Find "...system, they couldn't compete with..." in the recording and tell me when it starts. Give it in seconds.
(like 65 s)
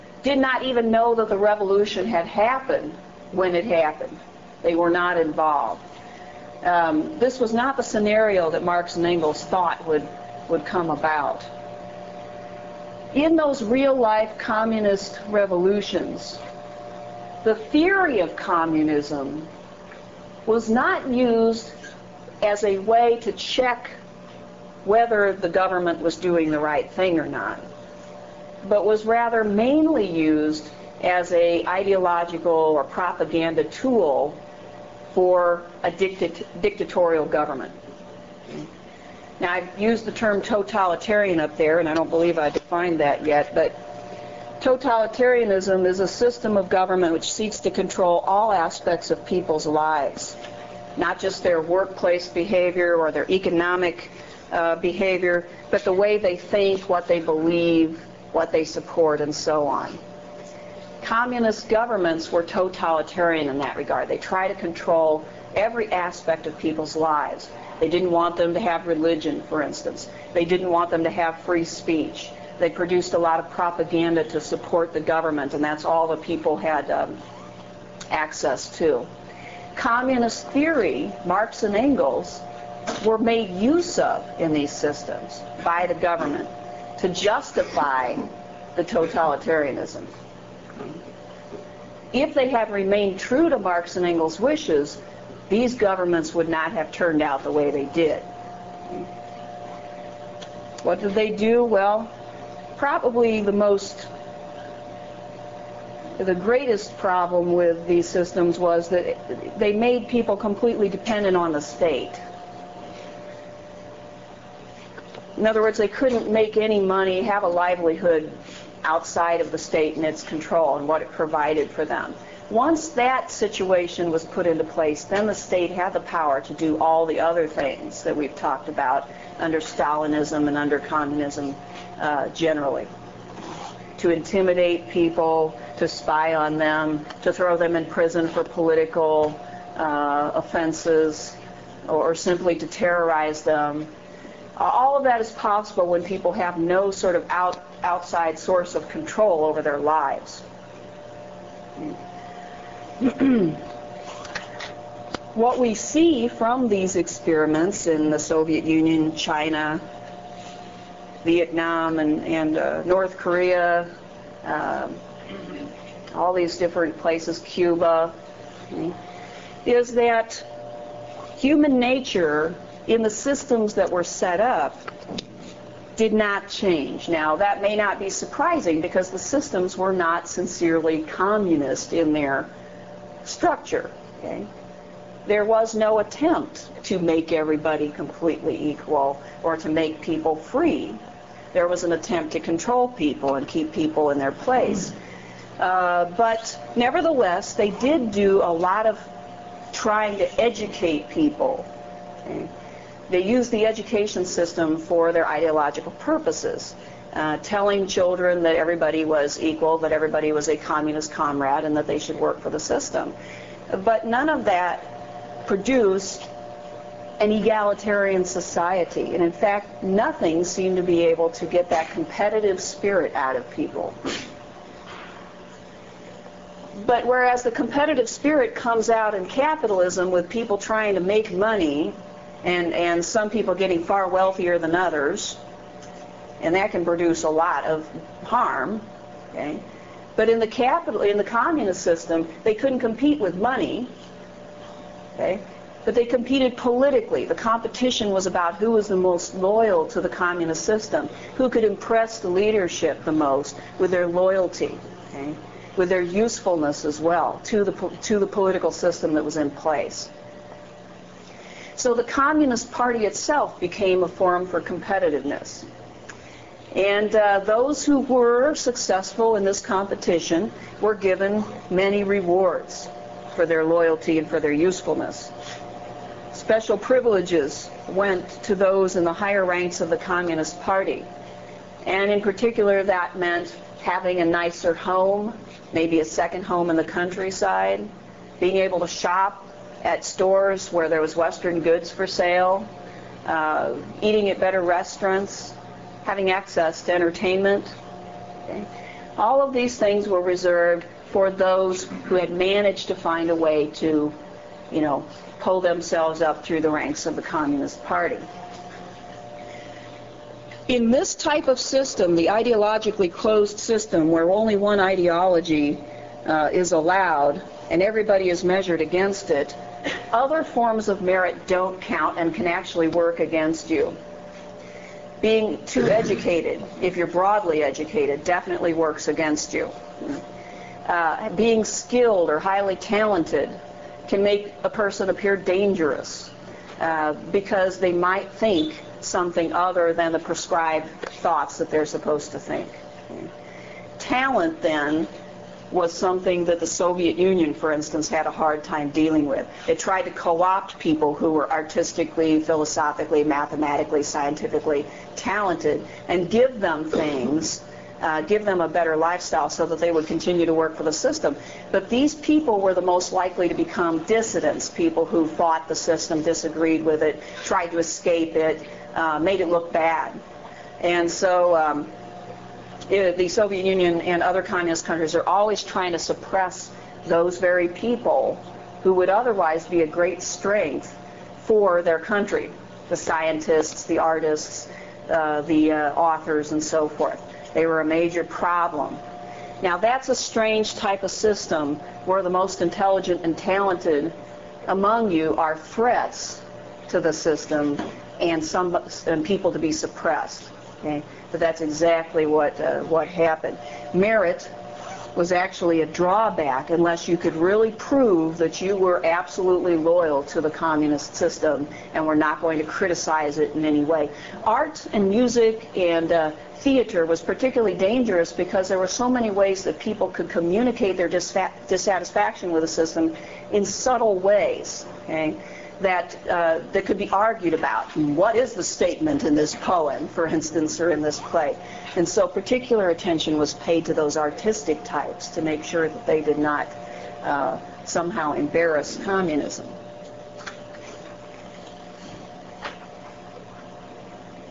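241 s.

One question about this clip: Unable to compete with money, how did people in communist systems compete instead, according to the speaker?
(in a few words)
politically.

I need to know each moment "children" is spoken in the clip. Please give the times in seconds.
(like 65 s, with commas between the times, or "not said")
207 s.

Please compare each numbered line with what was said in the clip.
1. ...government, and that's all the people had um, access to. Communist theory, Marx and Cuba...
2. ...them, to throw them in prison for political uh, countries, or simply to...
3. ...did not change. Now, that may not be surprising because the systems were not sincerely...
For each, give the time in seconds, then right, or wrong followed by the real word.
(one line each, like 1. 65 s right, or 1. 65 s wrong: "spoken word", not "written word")
1. 74 s wrong: "Engels", not "Cuba"
2. 136 s wrong: "offenses", not "countries"
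3. 175 s right.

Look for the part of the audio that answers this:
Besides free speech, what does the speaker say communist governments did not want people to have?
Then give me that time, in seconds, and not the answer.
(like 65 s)
68 s.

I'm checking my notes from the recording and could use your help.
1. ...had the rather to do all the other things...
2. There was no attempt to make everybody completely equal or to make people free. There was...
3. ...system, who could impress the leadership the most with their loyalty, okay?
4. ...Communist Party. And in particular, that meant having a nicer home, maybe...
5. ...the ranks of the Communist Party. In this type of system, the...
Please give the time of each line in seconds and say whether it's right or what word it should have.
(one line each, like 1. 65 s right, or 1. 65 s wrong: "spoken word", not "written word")
1. 125 s wrong: "power", not "rather"
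2. 185 s right
3. 250 s right
4. 279 s right
5. 306 s right.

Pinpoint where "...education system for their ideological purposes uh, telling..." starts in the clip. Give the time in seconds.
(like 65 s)
203 s.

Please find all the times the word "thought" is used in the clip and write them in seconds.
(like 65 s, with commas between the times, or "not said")
9 s, 341 s.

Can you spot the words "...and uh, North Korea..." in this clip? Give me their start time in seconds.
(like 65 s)
162 s.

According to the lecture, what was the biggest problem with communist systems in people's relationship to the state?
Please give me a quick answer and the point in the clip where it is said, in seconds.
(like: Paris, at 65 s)
completely dependent on the state, at 110 s.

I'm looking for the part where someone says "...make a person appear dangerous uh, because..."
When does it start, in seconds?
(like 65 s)
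334 s.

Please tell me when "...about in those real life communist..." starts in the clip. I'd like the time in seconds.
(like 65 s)
10 s.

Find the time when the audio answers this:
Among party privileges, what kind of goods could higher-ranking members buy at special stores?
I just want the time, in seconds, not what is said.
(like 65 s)
291 s.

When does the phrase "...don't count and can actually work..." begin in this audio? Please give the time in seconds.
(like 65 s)
321 s.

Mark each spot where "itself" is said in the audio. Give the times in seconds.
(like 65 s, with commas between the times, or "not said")
263 s.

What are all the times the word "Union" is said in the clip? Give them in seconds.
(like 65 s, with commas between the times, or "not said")
158 s, 347 s, 373 s.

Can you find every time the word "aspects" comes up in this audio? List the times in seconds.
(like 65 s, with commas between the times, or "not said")
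48 s, 65 s.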